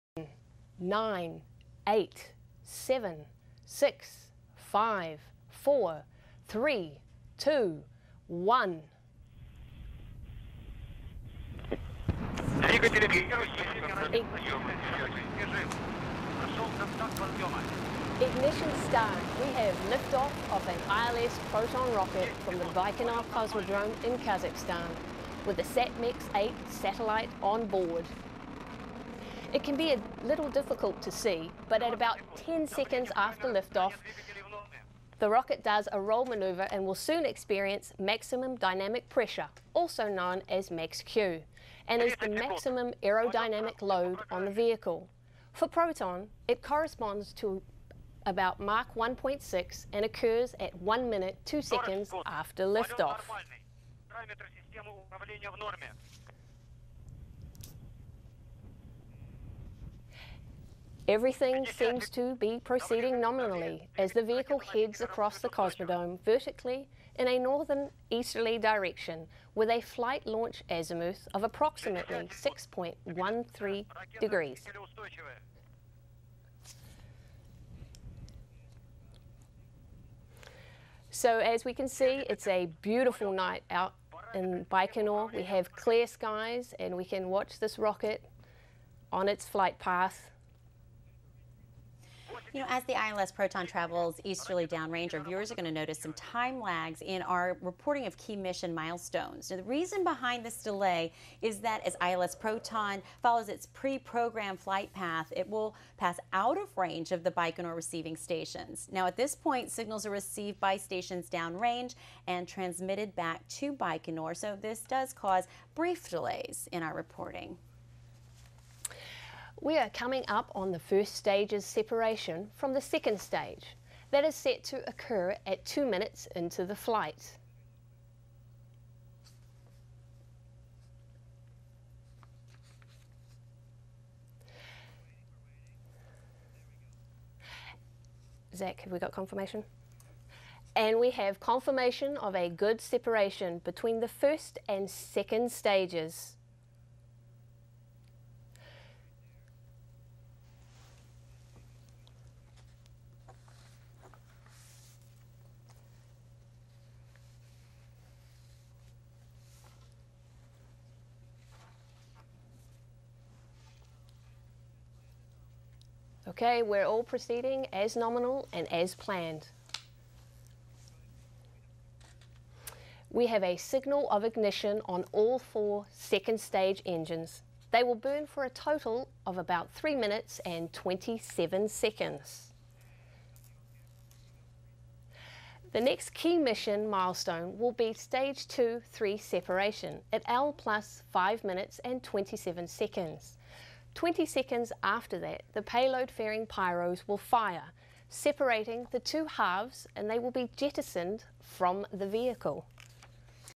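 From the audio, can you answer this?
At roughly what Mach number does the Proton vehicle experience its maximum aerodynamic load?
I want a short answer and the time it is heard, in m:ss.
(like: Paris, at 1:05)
1.6, at 0:48.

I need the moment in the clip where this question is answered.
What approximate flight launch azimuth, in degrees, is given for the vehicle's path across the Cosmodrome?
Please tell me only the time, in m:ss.
1:12.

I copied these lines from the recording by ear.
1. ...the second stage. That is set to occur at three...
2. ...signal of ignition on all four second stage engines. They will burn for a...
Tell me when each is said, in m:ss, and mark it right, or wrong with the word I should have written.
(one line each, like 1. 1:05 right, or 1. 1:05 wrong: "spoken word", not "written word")
1. 2:02 wrong: "two", not "three"
2. 2:53 right.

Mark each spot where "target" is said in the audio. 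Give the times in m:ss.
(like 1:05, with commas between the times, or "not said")
not said.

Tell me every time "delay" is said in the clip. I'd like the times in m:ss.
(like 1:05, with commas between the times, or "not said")
1:40, 1:56.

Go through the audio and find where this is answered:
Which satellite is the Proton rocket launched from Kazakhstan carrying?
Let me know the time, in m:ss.
0:25.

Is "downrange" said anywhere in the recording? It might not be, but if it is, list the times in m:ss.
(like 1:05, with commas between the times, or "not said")
1:34, 1:51.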